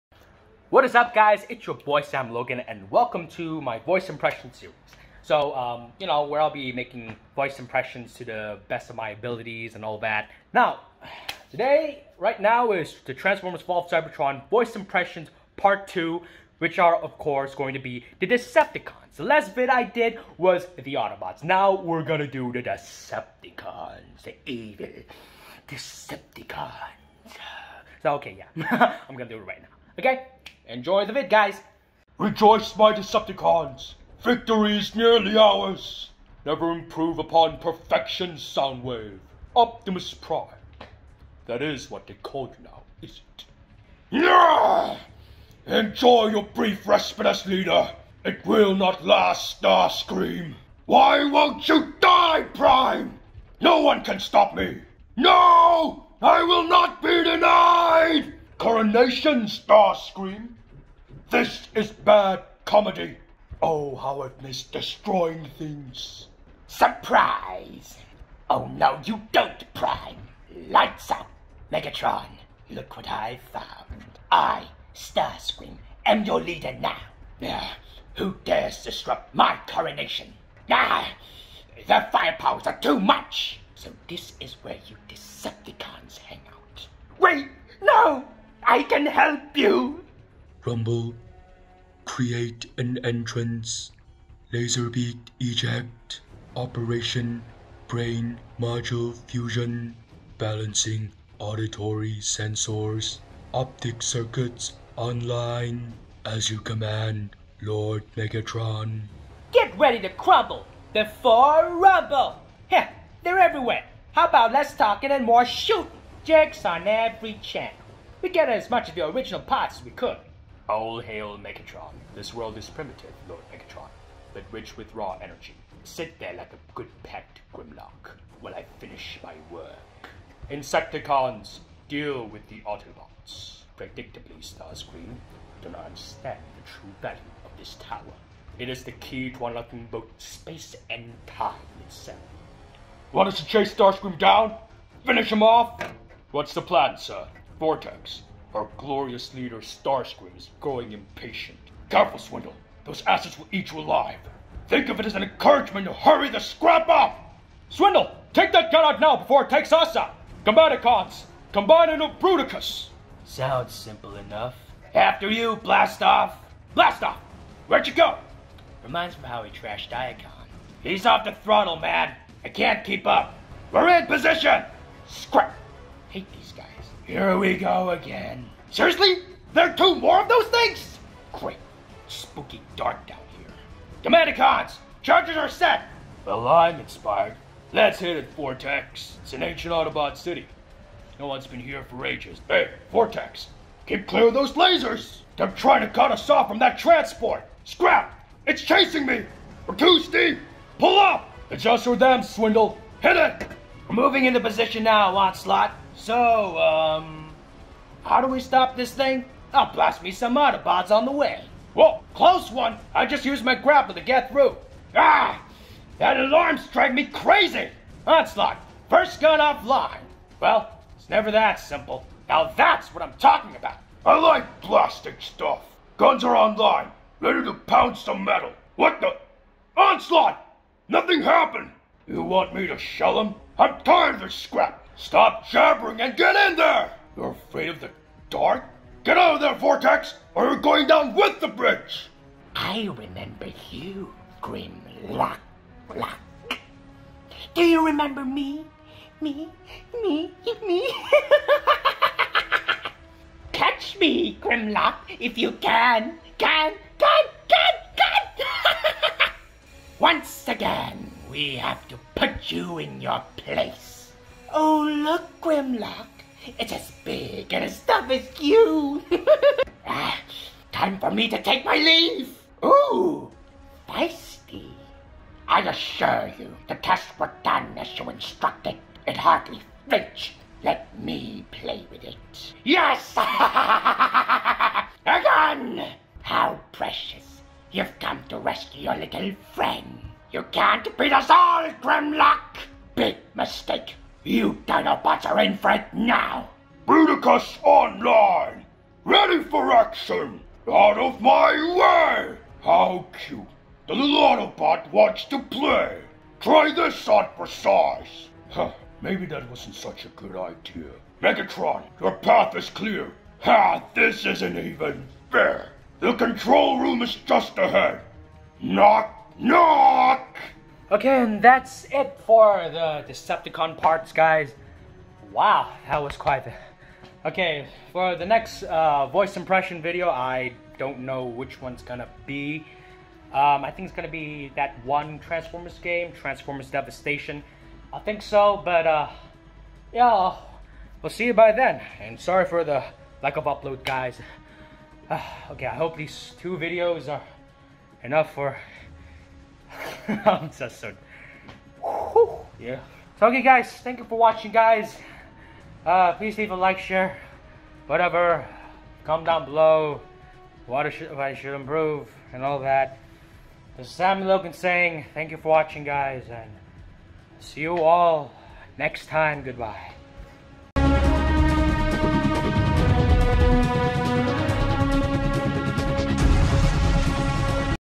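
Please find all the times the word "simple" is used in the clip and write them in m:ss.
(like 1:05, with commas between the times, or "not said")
2:43, 3:41.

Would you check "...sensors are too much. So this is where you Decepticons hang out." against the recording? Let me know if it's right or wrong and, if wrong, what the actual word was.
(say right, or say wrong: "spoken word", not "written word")
wrong: "firepowers", not "sensors".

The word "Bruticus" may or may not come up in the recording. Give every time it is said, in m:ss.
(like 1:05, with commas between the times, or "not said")
2:42, 4:56.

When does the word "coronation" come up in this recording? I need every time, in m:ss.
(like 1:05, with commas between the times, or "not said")
0:58, 1:19.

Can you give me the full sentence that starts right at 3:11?
No one's been here for ages.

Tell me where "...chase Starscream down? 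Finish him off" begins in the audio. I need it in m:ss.
2:23.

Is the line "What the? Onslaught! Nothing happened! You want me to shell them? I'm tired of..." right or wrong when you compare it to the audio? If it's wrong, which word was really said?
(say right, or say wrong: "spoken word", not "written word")
right.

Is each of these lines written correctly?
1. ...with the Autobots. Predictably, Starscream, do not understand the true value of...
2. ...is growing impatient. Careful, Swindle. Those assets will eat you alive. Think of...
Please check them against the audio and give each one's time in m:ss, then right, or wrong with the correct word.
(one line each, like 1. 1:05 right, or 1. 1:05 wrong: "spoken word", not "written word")
1. 2:12 right
2. 2:30 right.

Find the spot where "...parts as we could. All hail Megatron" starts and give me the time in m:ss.
1:59.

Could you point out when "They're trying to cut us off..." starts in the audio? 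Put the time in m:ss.
3:15.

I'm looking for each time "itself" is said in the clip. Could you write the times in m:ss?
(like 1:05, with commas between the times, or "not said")
2:21.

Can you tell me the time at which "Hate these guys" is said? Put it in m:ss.
2:56.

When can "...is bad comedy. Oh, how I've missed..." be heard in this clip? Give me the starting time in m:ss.
1:01.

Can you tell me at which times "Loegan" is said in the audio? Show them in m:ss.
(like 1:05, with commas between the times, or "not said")
0:02, 6:04.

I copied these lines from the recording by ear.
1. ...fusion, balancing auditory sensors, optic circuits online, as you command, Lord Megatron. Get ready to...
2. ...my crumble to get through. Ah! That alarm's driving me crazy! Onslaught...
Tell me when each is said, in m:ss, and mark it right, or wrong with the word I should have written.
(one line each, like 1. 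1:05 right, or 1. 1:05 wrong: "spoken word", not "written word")
1. 1:39 right
2. 3:33 wrong: "grapple", not "crumble".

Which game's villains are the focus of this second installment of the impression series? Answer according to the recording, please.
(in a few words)
Transformers Fall of Cybertron.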